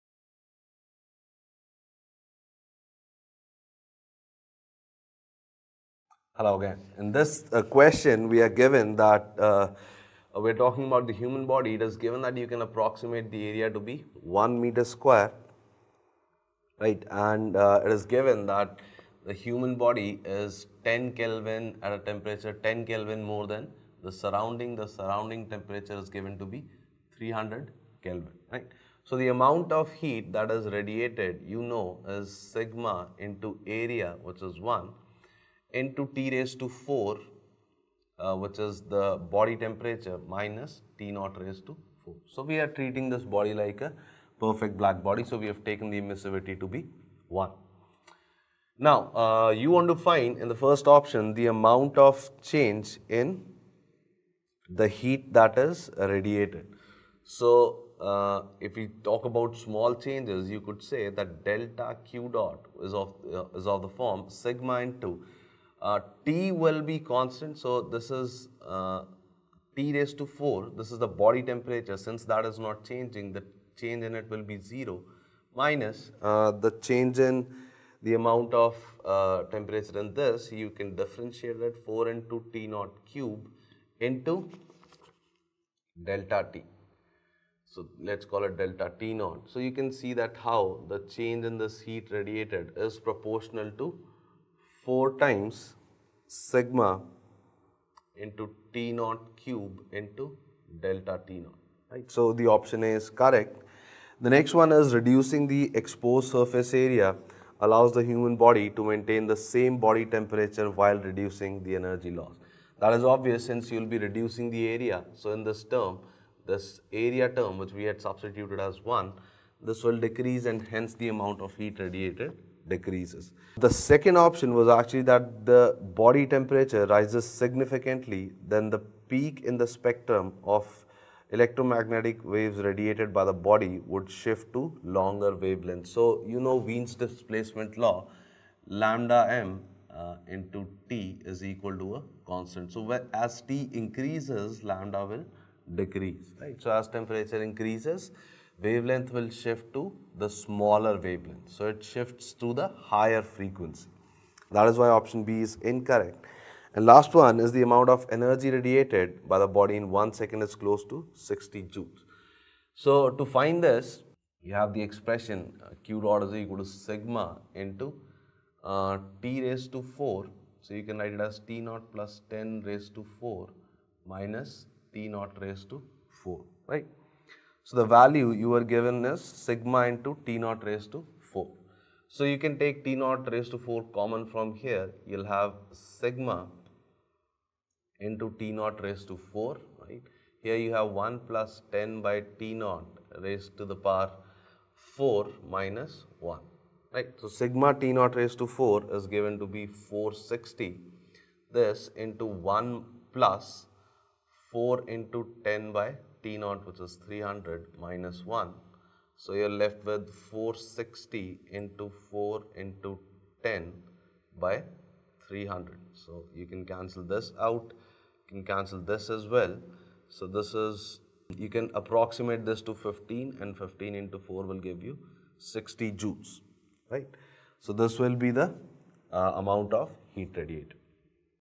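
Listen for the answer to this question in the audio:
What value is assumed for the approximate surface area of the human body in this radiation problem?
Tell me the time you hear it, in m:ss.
0:14.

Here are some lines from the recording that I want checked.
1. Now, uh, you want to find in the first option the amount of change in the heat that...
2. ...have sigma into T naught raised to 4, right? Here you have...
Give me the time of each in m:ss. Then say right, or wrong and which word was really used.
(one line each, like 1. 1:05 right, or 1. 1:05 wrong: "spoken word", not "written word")
1. 0:48 right
2. 3:05 right.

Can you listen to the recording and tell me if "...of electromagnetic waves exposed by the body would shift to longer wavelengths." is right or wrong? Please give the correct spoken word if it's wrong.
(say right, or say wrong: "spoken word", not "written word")
wrong: "radiated", not "exposed".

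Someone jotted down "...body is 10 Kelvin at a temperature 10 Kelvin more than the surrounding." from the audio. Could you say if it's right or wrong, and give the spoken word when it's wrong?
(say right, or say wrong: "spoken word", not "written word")
right.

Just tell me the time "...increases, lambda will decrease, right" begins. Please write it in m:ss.
2:23.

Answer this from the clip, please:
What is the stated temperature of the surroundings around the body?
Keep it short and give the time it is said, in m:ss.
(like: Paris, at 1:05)
300 Kelvin, at 0:27.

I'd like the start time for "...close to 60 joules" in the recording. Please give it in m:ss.
2:40.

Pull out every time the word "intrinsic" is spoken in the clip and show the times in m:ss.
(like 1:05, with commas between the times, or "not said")
not said.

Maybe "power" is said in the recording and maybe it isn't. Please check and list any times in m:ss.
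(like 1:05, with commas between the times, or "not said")
3:13.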